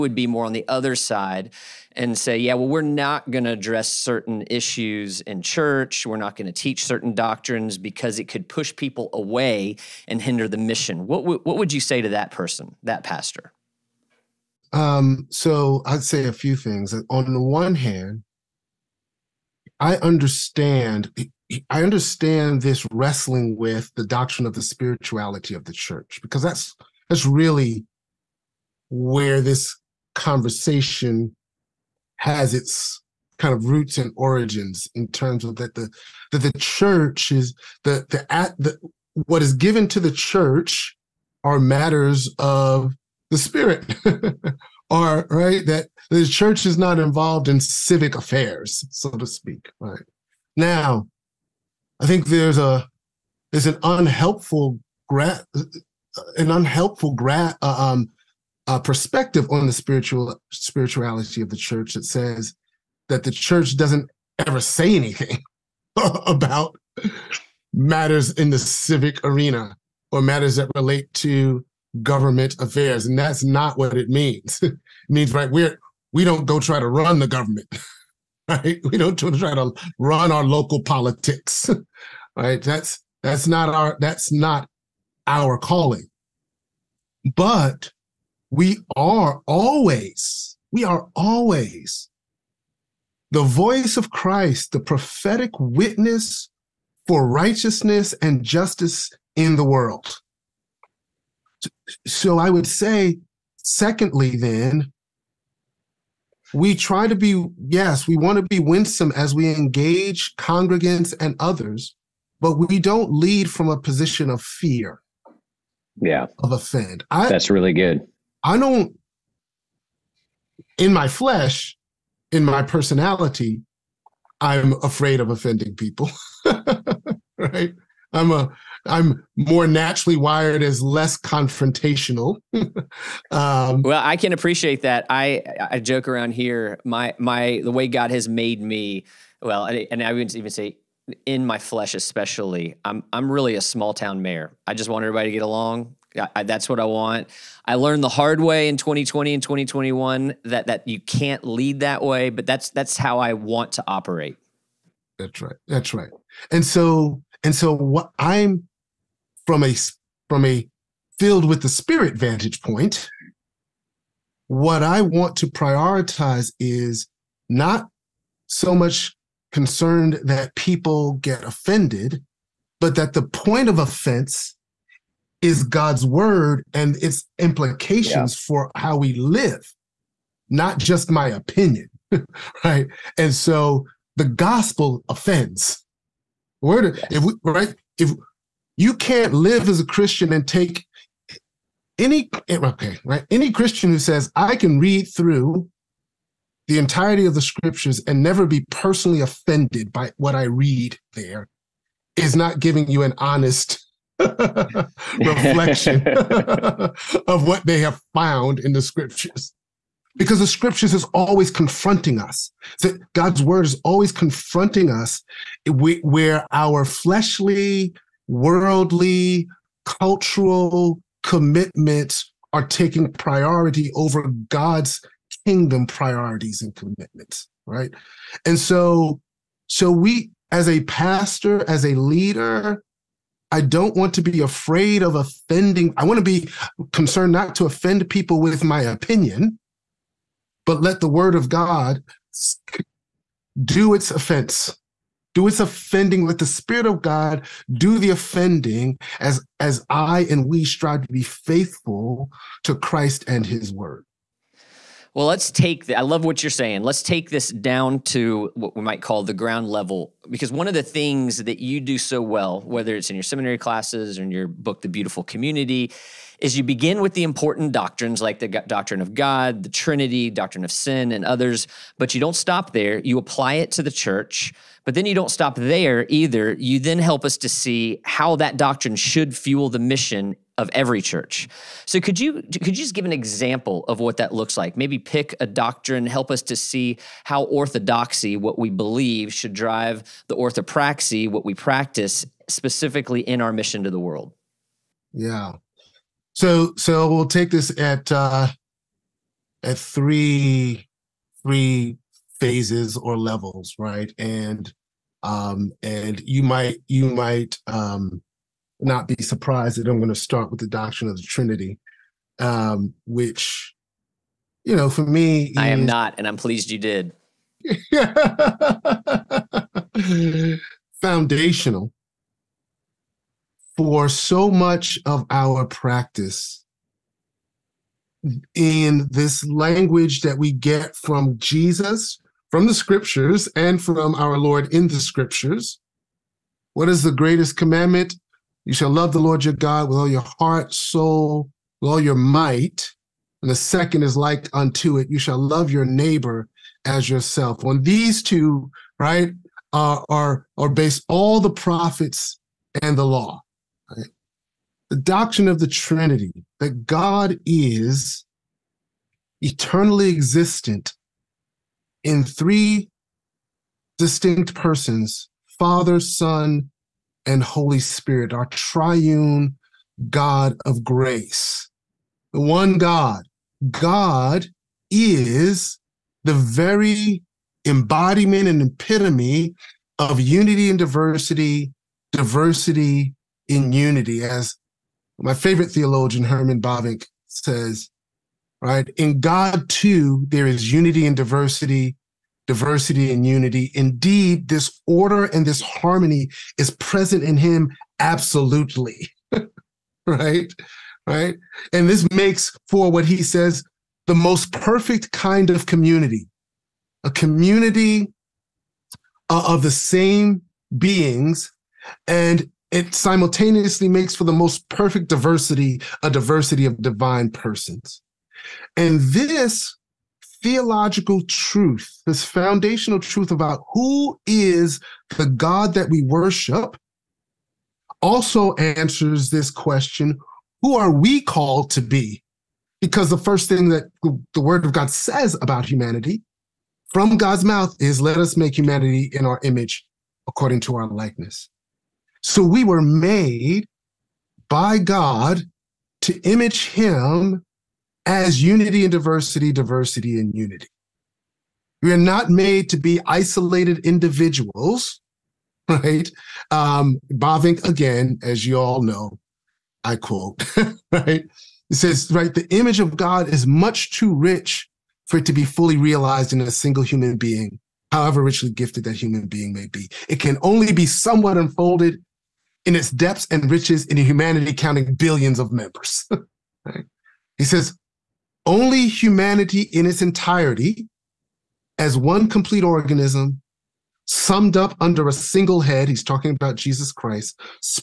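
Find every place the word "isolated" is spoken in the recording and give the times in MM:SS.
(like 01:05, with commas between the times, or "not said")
07:33.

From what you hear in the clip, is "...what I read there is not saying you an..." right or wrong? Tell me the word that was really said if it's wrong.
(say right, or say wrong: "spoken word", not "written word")
wrong: "giving", not "saying".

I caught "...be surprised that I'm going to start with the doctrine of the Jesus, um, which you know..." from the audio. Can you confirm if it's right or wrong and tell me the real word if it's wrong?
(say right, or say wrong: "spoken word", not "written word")
wrong: "Trinity", not "Jesus".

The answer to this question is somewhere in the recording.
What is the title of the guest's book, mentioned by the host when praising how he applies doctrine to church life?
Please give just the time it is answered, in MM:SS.
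04:24.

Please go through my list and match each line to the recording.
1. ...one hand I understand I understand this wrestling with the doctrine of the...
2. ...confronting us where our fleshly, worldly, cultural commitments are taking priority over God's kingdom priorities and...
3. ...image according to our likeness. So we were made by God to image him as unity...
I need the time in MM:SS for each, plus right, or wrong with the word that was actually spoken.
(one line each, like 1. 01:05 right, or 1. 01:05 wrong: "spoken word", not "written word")
1. 00:17 right
2. 03:34 right
3. 07:19 right.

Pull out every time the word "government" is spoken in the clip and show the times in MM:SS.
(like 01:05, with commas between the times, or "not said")
01:12, 01:17.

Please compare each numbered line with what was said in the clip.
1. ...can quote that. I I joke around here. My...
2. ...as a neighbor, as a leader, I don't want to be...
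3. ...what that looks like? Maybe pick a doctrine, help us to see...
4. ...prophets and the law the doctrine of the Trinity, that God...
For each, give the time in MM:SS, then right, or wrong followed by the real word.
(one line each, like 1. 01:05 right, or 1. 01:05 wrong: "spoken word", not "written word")
1. 02:14 wrong: "appreciate", not "quote"
2. 03:50 wrong: "pastor", not "neighbor"
3. 04:43 right
4. 05:51 right.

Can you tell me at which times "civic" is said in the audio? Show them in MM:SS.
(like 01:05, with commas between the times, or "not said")
00:47, 01:08.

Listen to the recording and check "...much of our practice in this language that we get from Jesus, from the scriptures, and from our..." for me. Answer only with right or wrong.
right.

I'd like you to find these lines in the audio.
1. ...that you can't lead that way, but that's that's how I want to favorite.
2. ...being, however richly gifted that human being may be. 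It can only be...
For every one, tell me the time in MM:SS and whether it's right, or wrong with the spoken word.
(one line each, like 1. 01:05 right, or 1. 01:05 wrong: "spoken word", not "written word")
1. 02:30 wrong: "operate", not "favorite"
2. 07:47 right.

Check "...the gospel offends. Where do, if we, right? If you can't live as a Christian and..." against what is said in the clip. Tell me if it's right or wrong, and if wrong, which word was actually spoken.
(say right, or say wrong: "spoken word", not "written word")
right.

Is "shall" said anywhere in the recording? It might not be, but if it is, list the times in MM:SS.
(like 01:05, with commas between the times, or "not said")
05:38, 05:45.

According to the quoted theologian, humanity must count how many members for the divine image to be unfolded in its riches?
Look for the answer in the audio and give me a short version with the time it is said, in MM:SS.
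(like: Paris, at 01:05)
billions, at 07:54.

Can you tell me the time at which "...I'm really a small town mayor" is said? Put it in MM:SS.
02:23.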